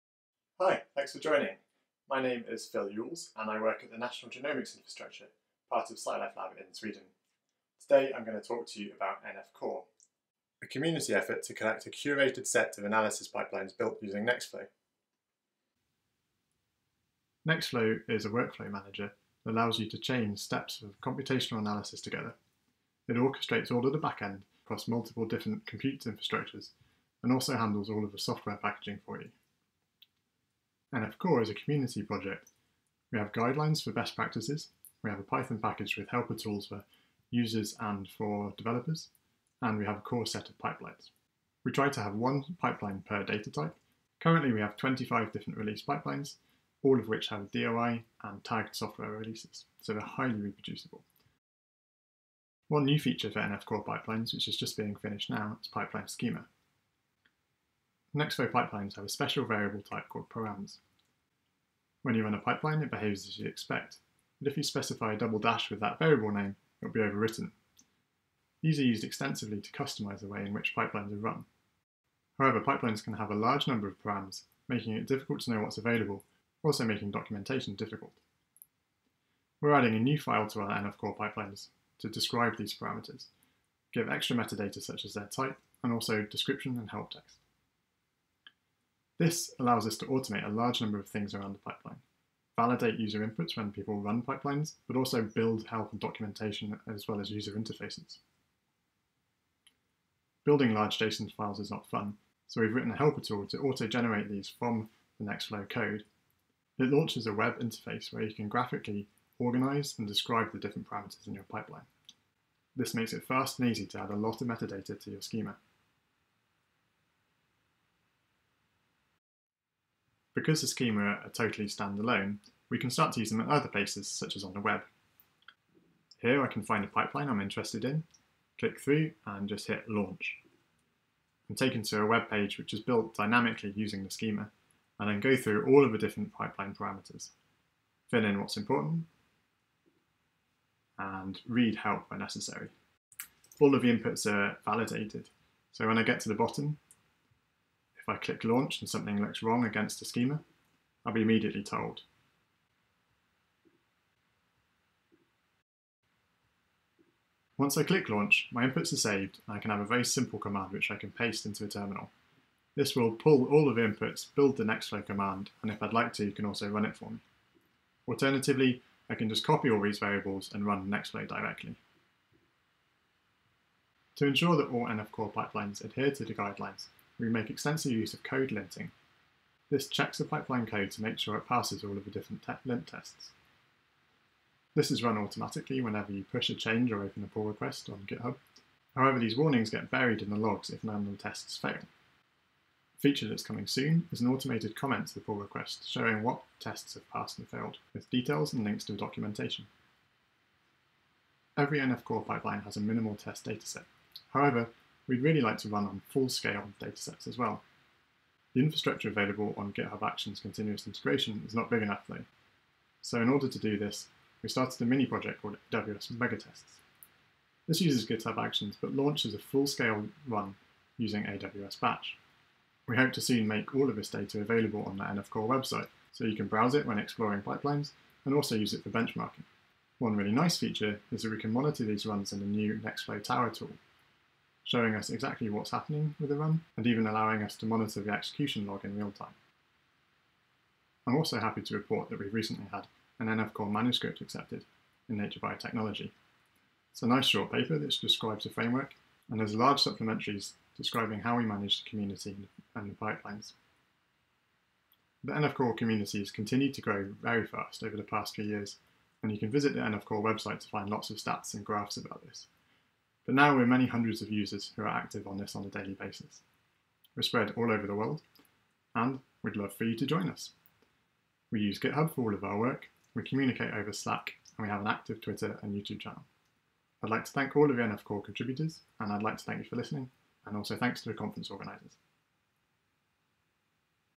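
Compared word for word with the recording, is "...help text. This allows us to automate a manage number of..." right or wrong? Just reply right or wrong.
wrong.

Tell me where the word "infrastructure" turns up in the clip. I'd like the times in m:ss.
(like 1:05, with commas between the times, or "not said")
0:04, 0:26, 3:28.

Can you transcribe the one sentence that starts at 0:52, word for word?
One new feature for NF Core pipelines, which is just being finished now, is pipeline schema.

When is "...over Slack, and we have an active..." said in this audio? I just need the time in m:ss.
4:33.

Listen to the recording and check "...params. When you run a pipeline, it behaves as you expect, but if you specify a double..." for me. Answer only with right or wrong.
right.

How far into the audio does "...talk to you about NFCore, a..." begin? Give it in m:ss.
0:08.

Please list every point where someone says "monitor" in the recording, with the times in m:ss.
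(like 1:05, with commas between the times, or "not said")
3:51, 3:57.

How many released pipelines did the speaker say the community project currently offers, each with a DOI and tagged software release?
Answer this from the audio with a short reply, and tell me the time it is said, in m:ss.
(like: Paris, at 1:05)
25, at 0:44.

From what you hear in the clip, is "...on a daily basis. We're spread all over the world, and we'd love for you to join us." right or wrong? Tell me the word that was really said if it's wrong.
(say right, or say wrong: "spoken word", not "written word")
right.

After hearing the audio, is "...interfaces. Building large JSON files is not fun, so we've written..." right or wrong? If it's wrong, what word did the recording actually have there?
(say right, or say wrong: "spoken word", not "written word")
right.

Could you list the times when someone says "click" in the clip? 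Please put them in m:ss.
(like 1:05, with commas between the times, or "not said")
2:08, 2:28, 2:37.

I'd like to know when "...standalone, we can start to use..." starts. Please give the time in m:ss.
2:01.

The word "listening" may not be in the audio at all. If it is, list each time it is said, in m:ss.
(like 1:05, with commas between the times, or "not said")
4:39.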